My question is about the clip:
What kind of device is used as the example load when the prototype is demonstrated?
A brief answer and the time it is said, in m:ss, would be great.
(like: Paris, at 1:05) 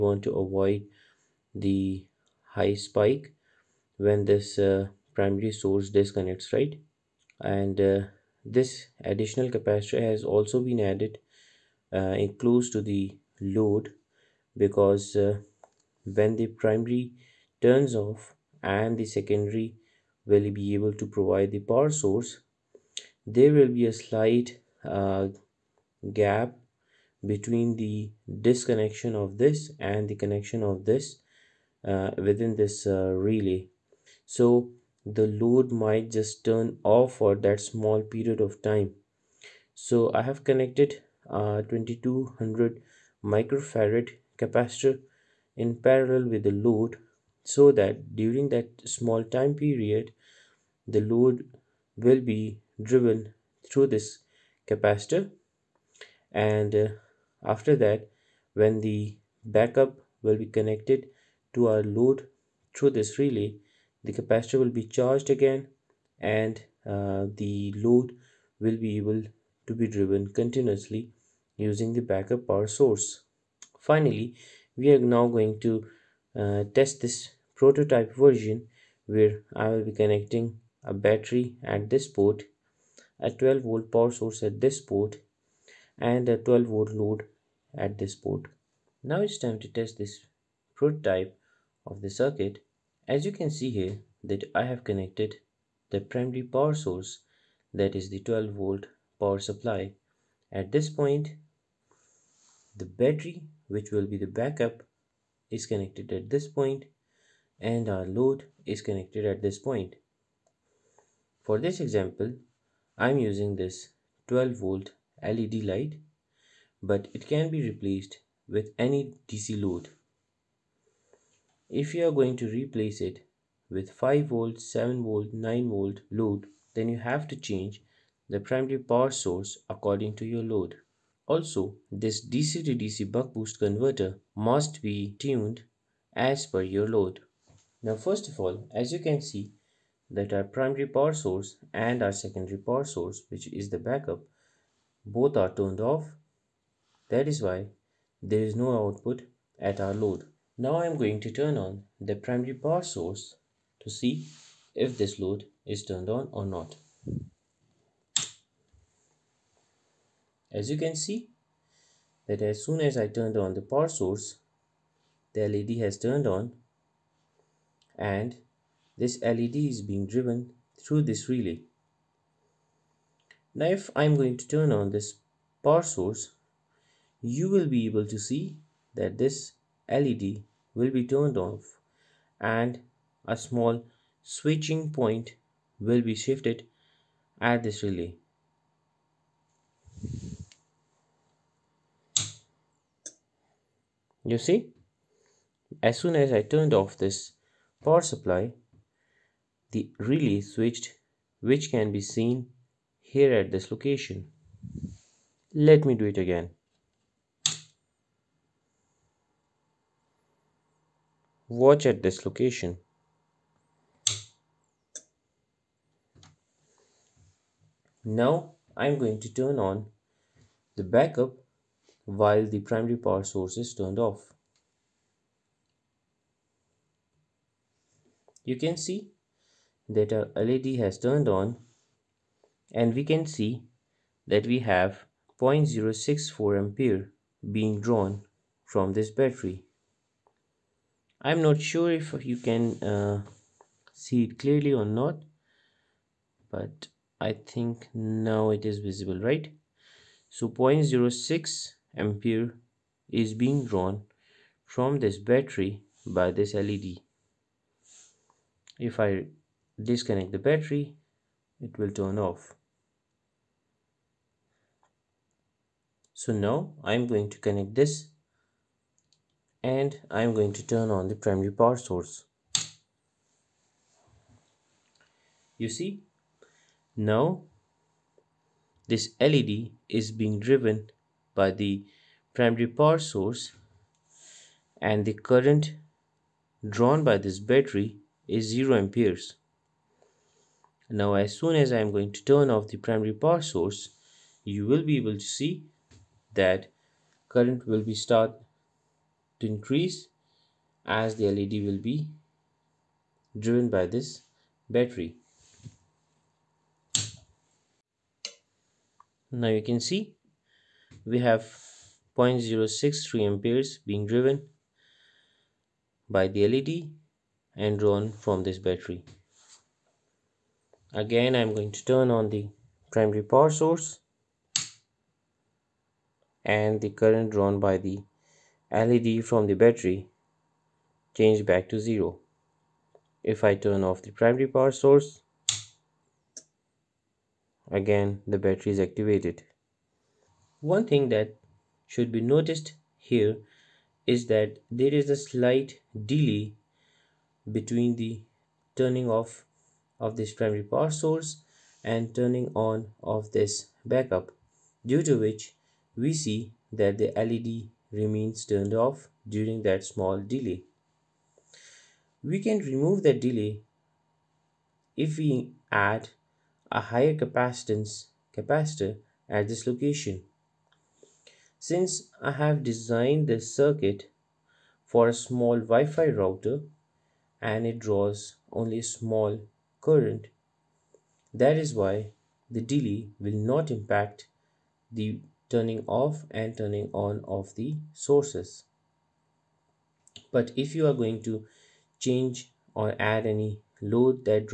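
12 volt LED light, at 1:54.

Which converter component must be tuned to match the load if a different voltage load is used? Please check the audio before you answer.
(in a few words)
DC to DC buck boost converter.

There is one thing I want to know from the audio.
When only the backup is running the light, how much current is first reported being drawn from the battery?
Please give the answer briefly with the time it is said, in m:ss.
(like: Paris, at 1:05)
0.064 ampere, at 3:55.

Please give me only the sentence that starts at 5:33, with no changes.
If I turn off the primary power source, again the battery is activated.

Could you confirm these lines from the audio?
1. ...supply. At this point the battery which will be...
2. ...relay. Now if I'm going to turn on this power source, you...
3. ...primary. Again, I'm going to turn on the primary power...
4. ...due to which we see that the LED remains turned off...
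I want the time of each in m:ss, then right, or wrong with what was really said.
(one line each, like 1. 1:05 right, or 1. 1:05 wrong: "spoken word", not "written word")
1. 1:39 right
2. 2:51 right
3. 5:18 wrong: "battery", not "primary"
4. 5:54 right.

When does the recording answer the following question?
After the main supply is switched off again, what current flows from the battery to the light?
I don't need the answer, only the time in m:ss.
5:12.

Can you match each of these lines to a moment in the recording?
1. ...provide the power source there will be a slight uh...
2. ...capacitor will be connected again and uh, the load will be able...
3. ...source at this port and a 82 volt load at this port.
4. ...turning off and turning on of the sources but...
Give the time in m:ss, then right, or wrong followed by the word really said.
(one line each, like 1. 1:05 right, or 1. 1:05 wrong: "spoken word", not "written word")
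1. 0:21 right
2. 1:04 wrong: "charged", not "connected"
3. 1:24 wrong: "12", not "82"
4. 6:25 right.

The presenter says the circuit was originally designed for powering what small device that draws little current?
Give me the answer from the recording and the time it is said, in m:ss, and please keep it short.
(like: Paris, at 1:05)
Wi-Fi router, at 6:15.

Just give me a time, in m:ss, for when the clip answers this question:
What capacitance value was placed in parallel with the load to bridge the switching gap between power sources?
0:41.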